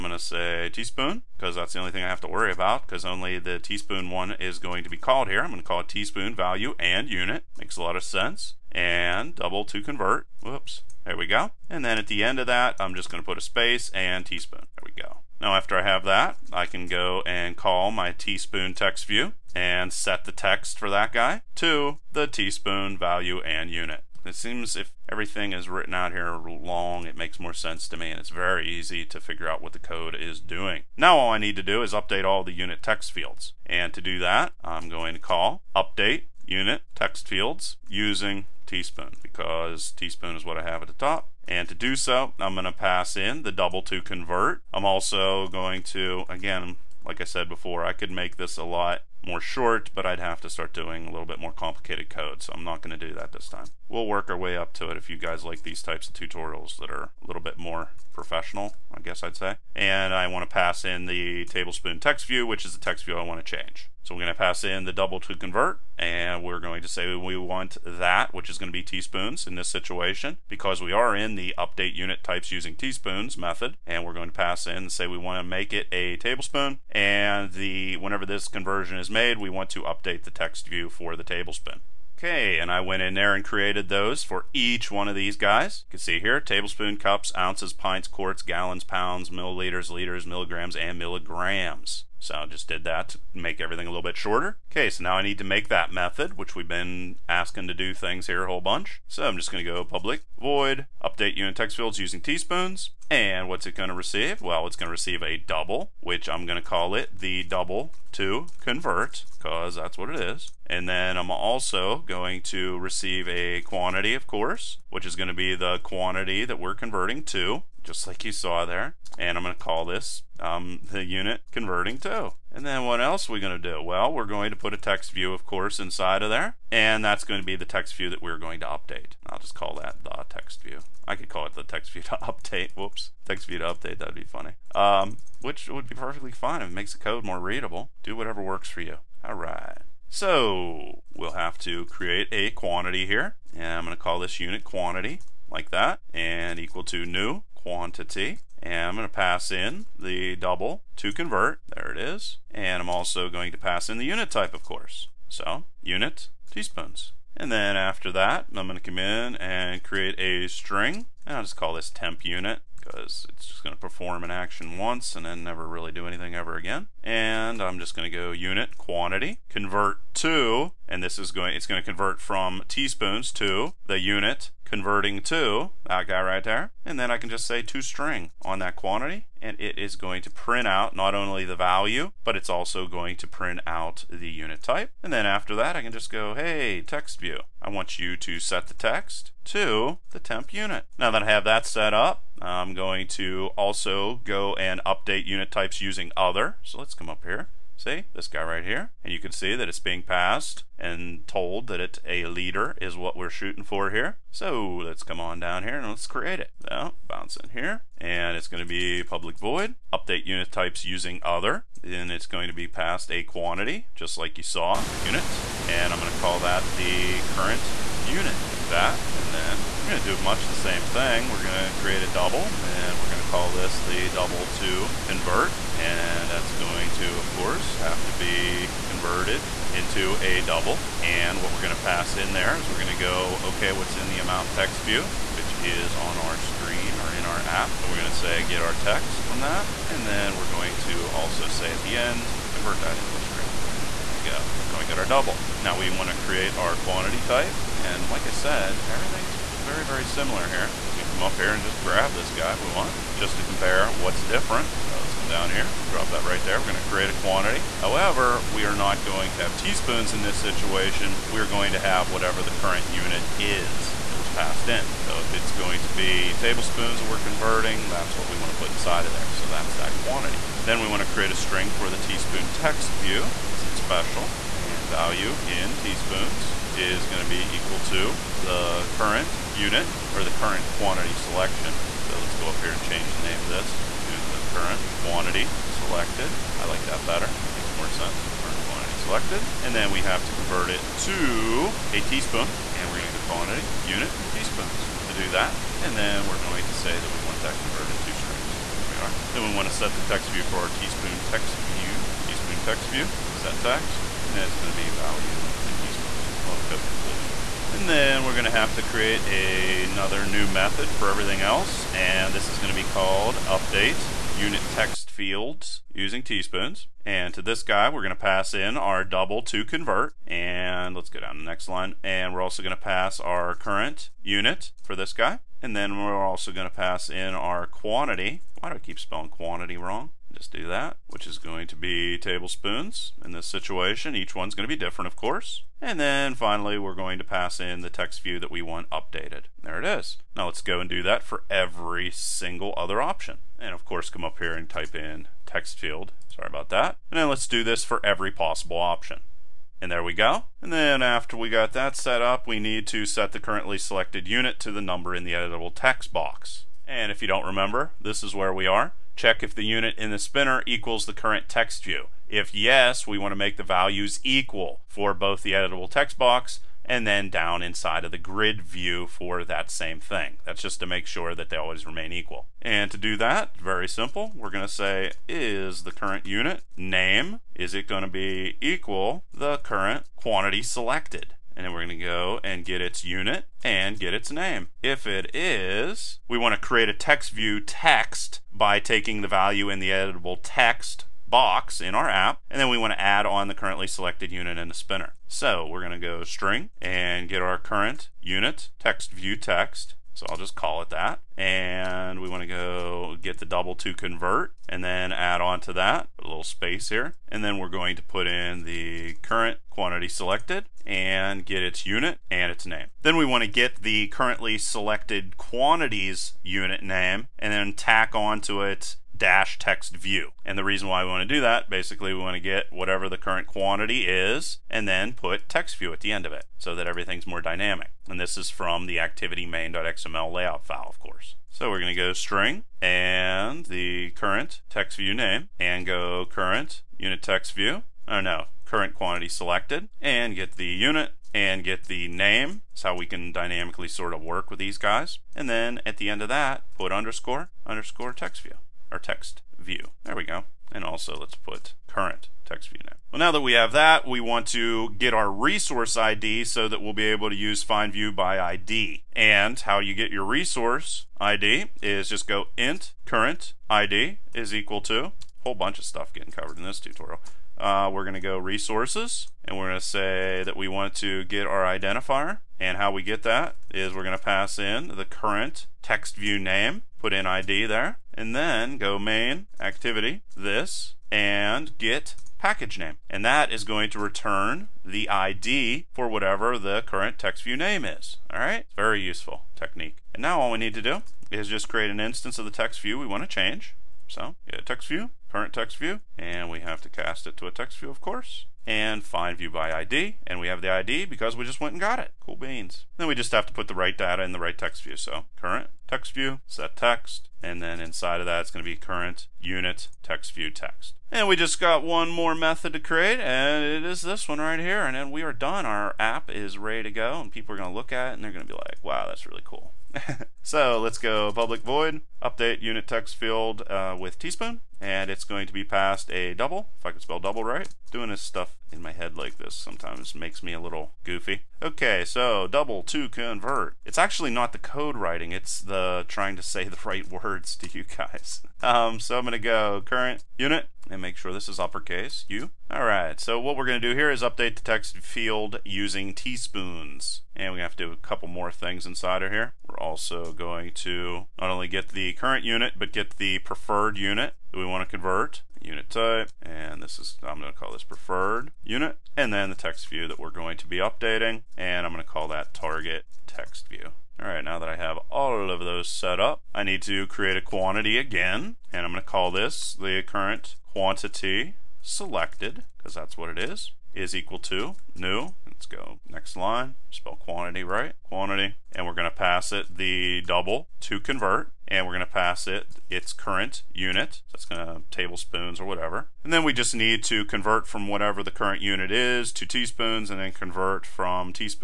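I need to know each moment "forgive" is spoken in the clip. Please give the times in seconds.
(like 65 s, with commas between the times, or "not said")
not said.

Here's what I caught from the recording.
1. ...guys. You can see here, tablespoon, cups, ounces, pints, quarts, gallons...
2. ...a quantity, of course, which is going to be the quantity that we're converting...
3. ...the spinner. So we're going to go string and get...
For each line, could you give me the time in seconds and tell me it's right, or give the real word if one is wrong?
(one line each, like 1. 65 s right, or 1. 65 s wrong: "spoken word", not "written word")
1. 85 s right
2. 113 s right
3. 394 s right.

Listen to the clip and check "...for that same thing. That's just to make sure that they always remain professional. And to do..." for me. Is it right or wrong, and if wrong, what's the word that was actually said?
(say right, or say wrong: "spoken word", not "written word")
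wrong: "equal", not "professional".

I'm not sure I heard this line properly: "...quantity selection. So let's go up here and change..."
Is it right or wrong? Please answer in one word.
right.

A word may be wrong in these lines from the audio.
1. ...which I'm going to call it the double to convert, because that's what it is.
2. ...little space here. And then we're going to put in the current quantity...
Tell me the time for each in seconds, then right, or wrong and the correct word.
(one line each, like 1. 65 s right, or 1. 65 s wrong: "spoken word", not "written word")
1. 105 s right
2. 406 s right.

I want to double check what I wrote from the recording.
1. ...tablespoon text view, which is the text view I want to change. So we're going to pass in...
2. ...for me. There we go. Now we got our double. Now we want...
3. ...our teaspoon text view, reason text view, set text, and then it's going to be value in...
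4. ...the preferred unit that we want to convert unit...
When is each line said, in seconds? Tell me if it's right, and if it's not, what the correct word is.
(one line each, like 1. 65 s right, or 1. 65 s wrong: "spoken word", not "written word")
1. 61 s right
2. 243 s right
3. 300 s wrong: "teaspoon", not "reason"
4. 553 s right.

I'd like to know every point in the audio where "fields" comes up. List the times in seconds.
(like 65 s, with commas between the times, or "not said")
33 s, 37 s, 101 s, 315 s, 345 s, 523 s, 544 s.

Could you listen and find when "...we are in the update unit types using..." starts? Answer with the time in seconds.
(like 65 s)
70 s.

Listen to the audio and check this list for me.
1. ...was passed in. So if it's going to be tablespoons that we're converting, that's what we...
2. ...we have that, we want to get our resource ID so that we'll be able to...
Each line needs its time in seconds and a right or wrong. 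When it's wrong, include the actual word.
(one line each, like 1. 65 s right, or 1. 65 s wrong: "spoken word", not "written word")
1. 264 s right
2. 453 s right.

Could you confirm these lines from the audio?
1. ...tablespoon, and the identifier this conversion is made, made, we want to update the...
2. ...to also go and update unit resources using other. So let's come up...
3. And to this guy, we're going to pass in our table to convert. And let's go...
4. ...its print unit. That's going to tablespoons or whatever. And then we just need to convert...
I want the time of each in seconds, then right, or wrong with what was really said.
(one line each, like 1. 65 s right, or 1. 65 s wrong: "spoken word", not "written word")
1. 76 s wrong: "whenever", not "identifier"
2. 193 s wrong: "types", not "resources"
3. 317 s wrong: "double", not "table"
4. 582 s wrong: "current", not "print".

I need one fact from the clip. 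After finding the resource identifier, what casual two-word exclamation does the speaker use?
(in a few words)
Cool beans.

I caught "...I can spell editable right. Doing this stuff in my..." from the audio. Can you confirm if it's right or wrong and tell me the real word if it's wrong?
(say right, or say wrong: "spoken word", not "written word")
wrong: "double", not "editable".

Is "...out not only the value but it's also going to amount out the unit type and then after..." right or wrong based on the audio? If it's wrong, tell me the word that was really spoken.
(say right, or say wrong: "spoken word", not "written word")
wrong: "print", not "amount".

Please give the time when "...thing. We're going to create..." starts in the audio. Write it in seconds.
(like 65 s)
220 s.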